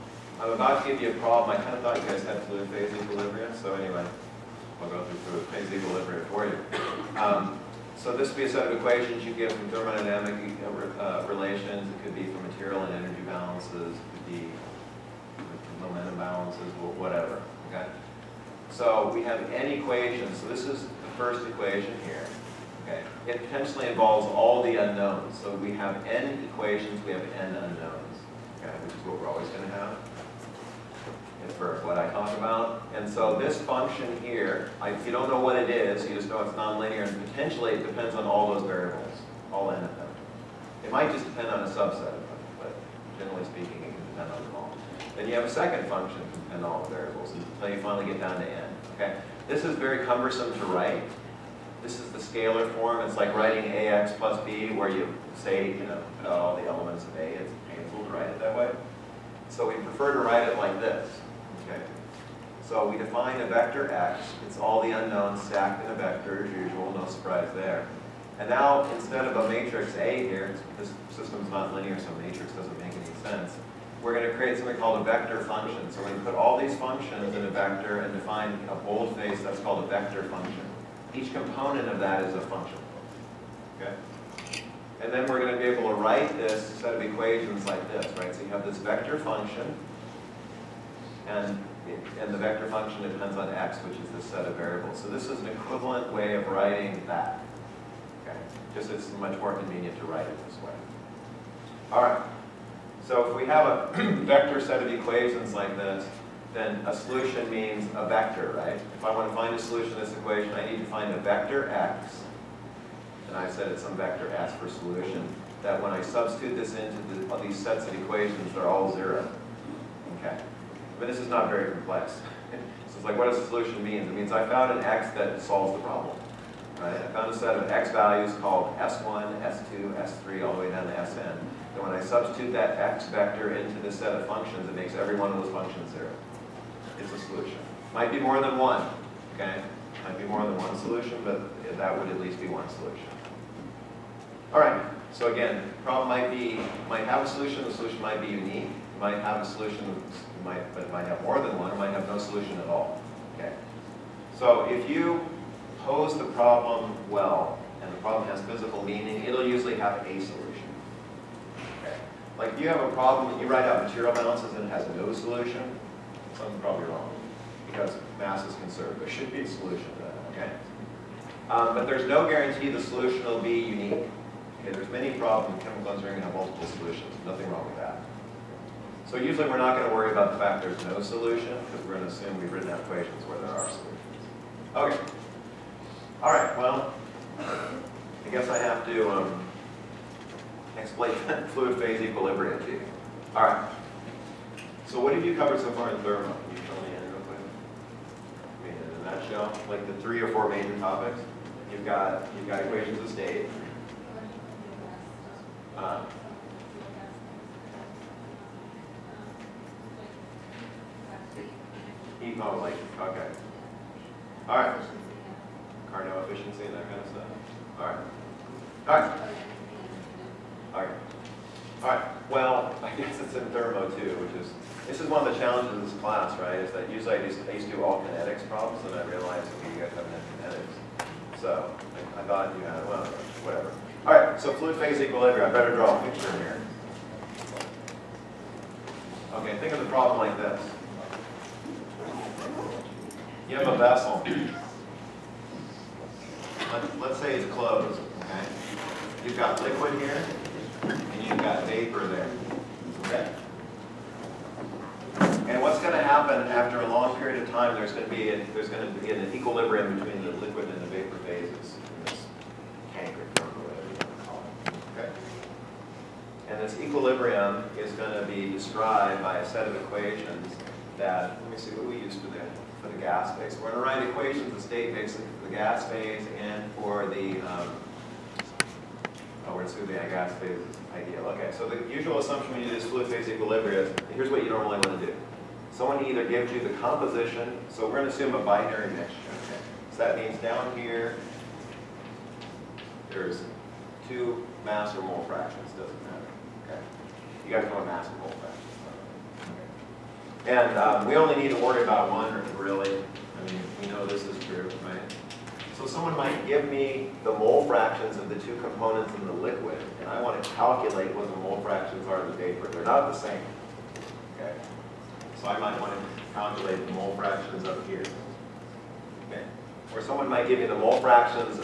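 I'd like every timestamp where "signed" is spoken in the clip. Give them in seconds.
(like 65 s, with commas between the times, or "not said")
not said.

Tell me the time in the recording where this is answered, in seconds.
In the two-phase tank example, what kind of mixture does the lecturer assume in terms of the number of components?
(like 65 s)
288 s.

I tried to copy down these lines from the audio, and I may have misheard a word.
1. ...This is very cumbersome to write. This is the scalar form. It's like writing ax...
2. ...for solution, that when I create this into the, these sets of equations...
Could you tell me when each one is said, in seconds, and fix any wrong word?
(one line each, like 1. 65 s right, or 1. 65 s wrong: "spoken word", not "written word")
1. 49 s right
2. 114 s wrong: "substitute", not "create".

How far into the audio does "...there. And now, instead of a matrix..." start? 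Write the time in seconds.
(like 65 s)
67 s.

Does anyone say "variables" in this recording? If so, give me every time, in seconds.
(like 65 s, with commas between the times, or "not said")
38 s, 46 s, 94 s.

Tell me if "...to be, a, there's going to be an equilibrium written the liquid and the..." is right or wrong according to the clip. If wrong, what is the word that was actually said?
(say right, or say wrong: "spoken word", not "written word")
wrong: "between", not "written".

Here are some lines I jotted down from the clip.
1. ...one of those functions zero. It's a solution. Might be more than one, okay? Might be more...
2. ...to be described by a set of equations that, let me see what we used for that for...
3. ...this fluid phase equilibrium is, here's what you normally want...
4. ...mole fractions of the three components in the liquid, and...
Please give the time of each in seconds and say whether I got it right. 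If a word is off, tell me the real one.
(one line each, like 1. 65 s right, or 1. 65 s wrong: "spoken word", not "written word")
1. 135 s right
2. 268 s right
3. 282 s right
4. 307 s wrong: "two", not "three".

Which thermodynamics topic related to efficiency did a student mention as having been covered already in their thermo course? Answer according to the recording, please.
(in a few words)
Carnot efficiency.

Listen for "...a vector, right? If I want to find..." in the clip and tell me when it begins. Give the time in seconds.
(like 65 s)
107 s.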